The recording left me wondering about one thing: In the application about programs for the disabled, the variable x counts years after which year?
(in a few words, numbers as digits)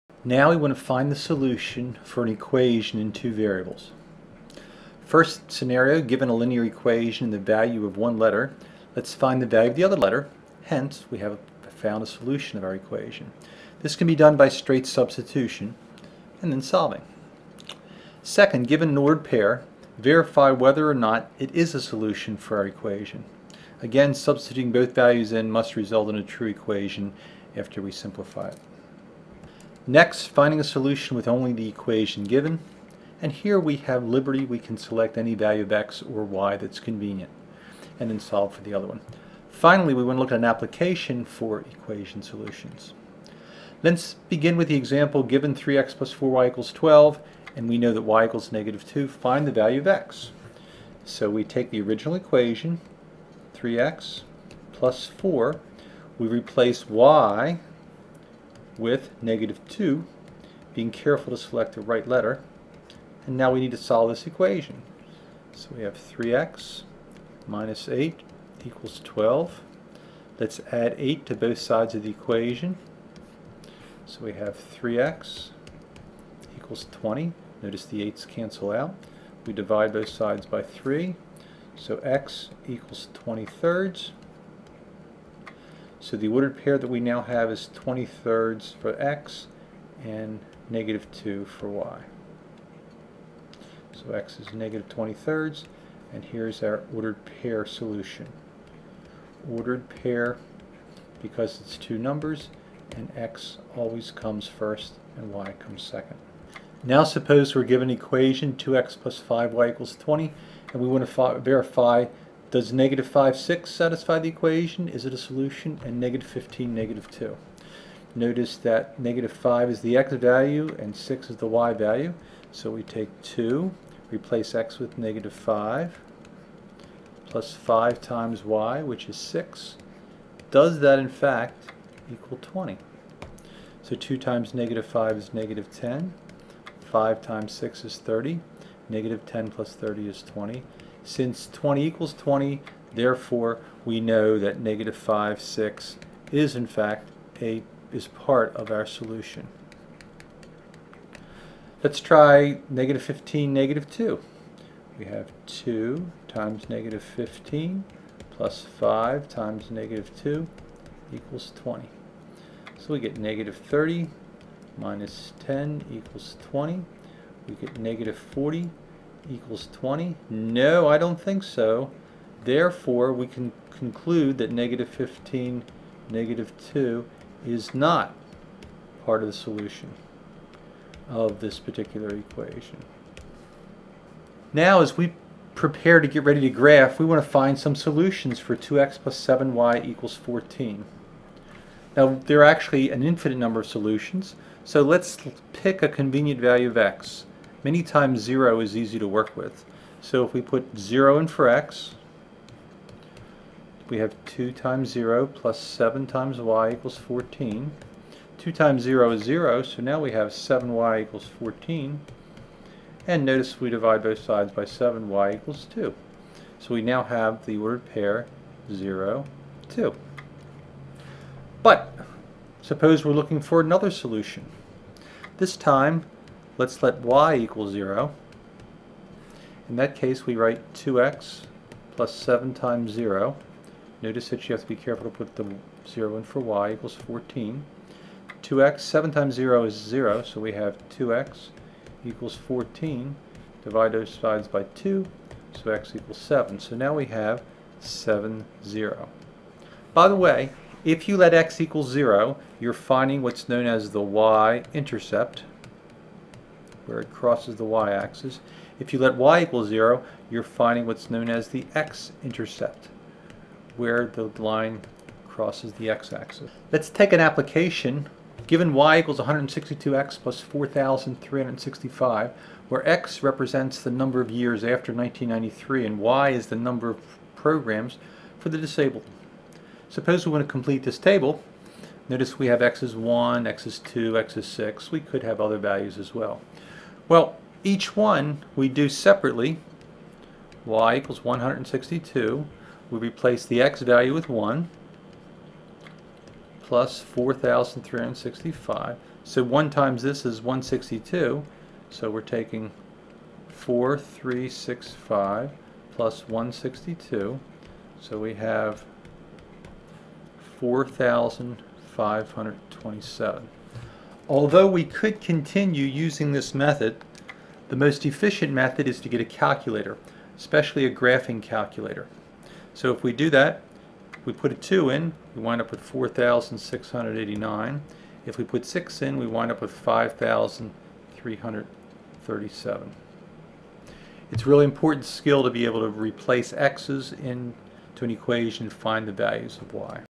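1993.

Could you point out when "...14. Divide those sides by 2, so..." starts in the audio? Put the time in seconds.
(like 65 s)
242 s.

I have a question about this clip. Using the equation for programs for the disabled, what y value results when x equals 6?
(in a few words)
5,337.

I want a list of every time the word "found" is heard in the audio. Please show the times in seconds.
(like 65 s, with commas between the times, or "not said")
11 s.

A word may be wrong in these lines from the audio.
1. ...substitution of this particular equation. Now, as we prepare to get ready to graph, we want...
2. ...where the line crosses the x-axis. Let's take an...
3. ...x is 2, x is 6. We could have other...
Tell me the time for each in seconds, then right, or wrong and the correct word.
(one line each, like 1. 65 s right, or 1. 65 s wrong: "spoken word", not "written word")
1. 179 s wrong: "solution", not "substitution"
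2. 263 s right
3. 283 s right.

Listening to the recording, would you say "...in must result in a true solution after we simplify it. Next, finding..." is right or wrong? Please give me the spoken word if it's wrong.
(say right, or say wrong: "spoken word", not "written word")
wrong: "equation", not "solution".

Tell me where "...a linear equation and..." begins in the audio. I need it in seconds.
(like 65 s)
6 s.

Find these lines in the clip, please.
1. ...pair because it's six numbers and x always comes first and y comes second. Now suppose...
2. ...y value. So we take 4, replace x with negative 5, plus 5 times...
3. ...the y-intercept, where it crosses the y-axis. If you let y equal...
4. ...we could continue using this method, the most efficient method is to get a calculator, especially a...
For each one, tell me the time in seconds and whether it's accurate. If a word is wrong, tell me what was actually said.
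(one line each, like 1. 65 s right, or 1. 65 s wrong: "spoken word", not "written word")
1. 99 s wrong: "two", not "six"
2. 121 s wrong: "2", not "4"
3. 253 s right
4. 314 s right.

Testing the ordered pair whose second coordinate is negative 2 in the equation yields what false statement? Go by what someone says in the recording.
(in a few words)
-40 = 20.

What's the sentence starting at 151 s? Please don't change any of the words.
Let's try negative 15, negative 2.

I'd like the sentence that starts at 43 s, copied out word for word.
Let's begin with the example given 3x plus 4y equals 12, and we know that y equals negative 2.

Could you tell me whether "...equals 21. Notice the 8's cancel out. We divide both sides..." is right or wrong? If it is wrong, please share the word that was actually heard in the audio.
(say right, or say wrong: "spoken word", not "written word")
wrong: "20", not "21".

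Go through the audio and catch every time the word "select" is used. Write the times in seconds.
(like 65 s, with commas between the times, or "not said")
34 s, 61 s.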